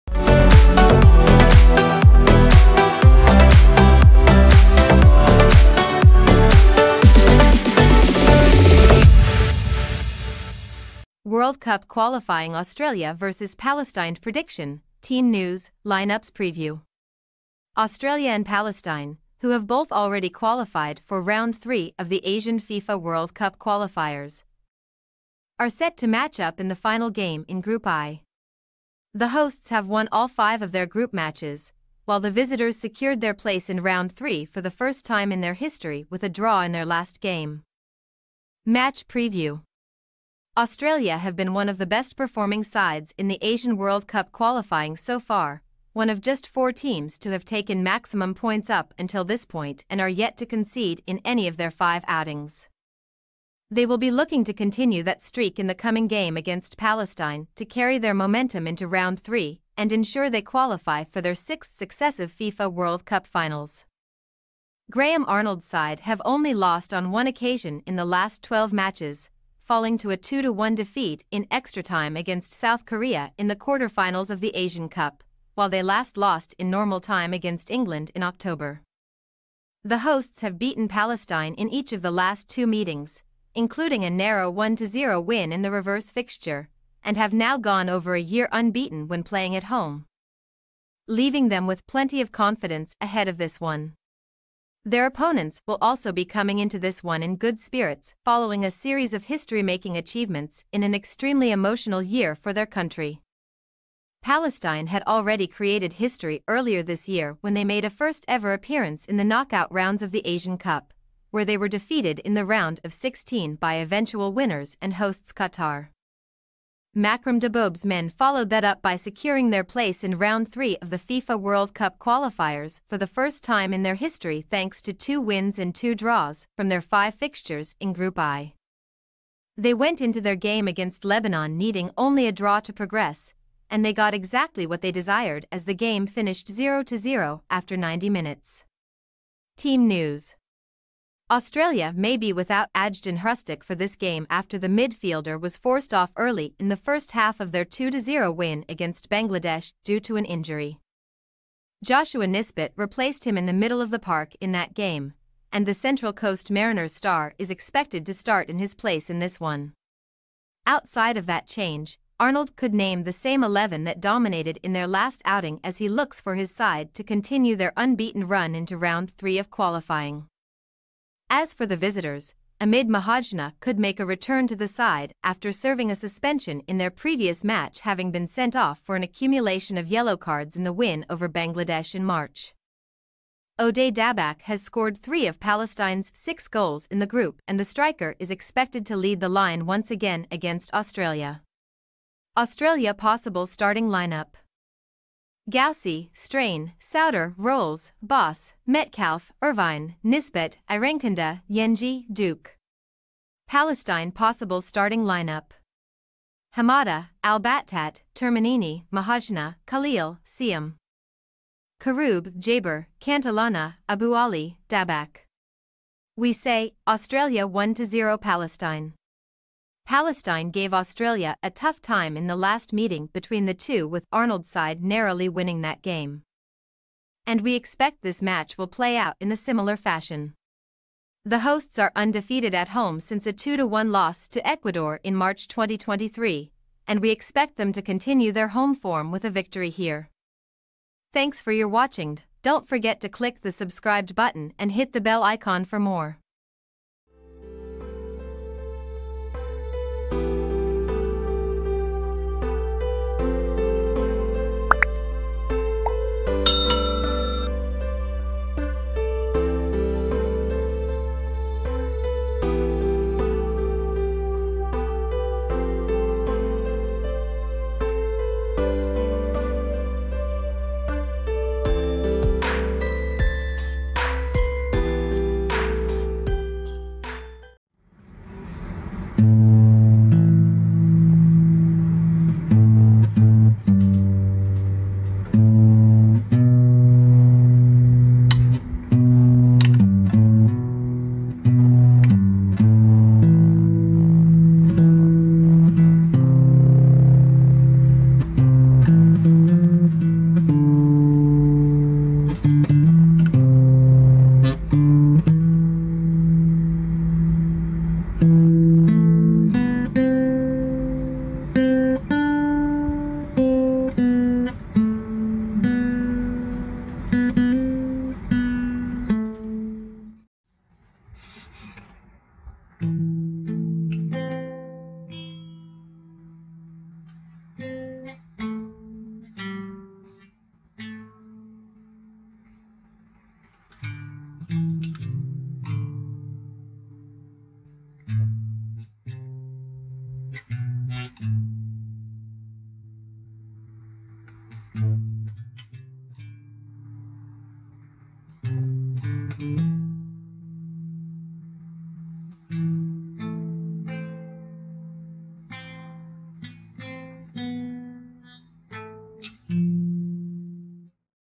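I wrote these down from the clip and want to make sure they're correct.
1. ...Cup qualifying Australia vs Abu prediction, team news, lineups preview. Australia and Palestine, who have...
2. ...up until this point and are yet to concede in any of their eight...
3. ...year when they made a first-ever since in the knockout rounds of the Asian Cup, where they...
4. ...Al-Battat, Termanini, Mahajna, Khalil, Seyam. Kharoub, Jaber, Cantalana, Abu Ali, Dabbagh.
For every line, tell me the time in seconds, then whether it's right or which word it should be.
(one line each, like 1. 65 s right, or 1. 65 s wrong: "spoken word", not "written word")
1. 11 s wrong: "Palestine", not "Abu"
2. 48 s wrong: "five", not "eight"
3. 107 s wrong: "appearance", not "since"
4. 207 s right.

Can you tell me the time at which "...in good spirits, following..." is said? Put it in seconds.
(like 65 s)
97 s.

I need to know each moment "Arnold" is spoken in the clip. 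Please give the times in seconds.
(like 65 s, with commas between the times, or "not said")
65 s, 162 s, 224 s.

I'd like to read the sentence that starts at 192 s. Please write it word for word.
Australia possible starting lineup Gauci, Strain, Souter, Rowles, Bos, Metcalfe, Irvine, Nisbet, Irankunda, Yengi, Duke.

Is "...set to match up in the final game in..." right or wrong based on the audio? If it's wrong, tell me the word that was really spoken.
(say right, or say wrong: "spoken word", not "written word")
right.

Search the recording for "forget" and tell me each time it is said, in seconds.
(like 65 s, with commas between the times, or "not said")
242 s.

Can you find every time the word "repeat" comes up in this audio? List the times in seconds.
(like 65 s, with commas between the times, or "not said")
not said.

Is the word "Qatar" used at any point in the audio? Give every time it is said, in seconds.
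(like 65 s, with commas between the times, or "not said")
115 s.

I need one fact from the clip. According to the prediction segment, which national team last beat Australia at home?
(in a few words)
Ecuador.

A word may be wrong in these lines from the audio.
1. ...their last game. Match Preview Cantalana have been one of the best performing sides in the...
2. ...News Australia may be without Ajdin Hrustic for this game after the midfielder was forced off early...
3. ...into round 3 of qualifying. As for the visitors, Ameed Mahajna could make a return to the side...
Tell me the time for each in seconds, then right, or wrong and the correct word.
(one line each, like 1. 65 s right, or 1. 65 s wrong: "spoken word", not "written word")
1. 36 s wrong: "Australia", not "Cantalana"
2. 139 s right
3. 168 s right.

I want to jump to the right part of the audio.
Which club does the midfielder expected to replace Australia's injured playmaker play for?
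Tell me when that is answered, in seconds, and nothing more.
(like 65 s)
155 s.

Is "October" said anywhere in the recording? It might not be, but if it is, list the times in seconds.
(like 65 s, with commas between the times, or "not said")
78 s.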